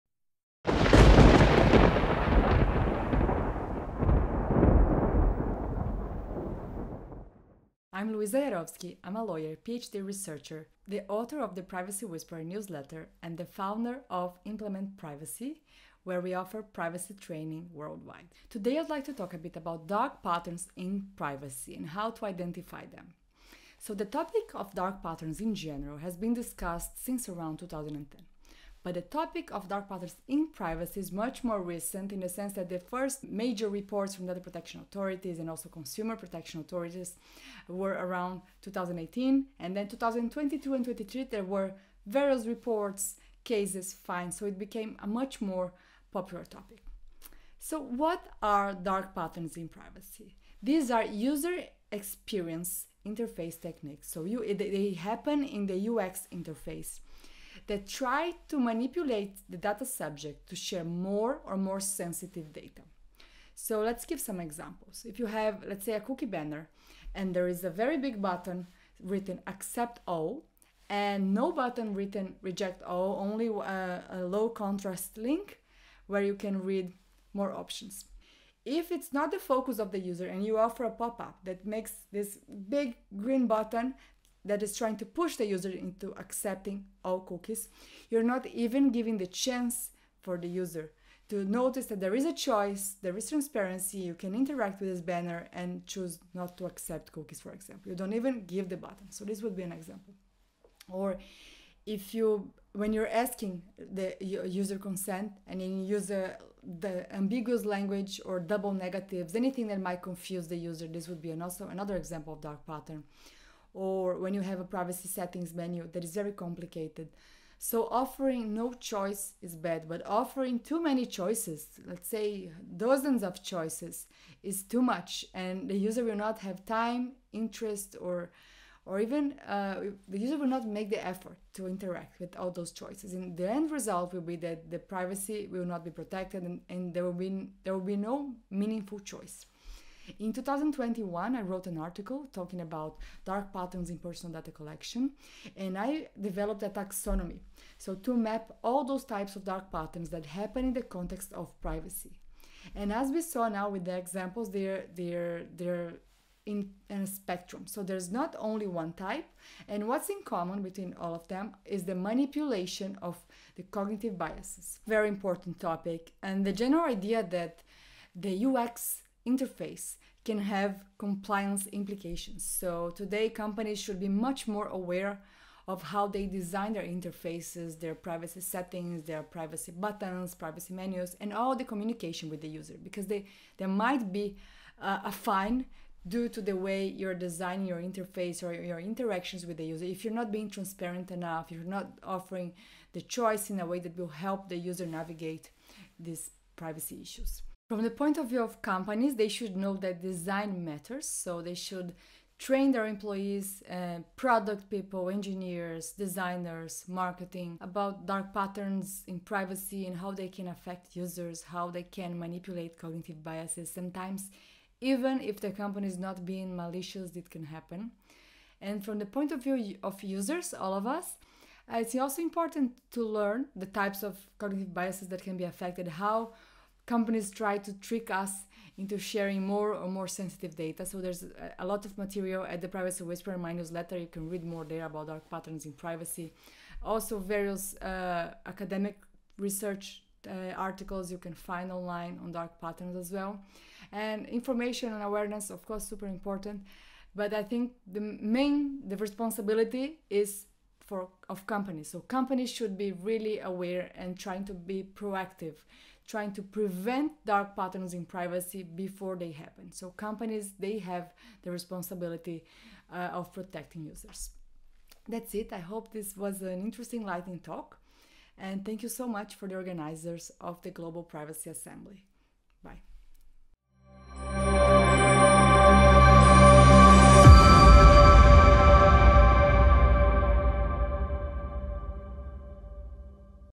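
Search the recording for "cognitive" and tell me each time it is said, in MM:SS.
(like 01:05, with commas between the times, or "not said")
02:43, 03:32, 03:44.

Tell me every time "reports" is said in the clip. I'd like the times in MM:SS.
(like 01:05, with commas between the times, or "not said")
00:33, 00:42.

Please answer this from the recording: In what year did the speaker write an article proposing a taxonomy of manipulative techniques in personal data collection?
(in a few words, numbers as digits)
2021.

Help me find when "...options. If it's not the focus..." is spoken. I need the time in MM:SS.
01:17.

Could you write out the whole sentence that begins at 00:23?
So, the topic of dark patterns in general has been discussed since around 2010.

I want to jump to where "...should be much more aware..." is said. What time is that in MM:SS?
02:53.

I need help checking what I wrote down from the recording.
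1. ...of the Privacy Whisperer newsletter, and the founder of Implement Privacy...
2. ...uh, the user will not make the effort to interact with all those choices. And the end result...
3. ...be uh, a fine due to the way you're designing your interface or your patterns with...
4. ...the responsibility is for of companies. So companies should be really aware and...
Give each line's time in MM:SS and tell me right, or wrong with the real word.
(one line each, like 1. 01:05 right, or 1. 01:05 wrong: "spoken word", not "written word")
1. 00:11 right
2. 02:09 right
3. 03:04 wrong: "interactions", not "patterns"
4. 04:08 right.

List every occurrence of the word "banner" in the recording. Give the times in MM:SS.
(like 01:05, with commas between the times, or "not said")
01:06, 01:35.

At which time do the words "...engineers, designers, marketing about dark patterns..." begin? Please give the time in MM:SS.
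03:25.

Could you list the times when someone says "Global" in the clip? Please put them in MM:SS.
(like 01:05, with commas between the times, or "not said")
04:30.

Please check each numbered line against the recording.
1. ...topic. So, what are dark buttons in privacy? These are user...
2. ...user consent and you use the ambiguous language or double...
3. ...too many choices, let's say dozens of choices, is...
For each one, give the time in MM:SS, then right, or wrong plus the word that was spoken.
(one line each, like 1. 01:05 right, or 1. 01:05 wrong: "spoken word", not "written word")
1. 00:46 wrong: "patterns", not "buttons"
2. 01:44 right
3. 02:00 right.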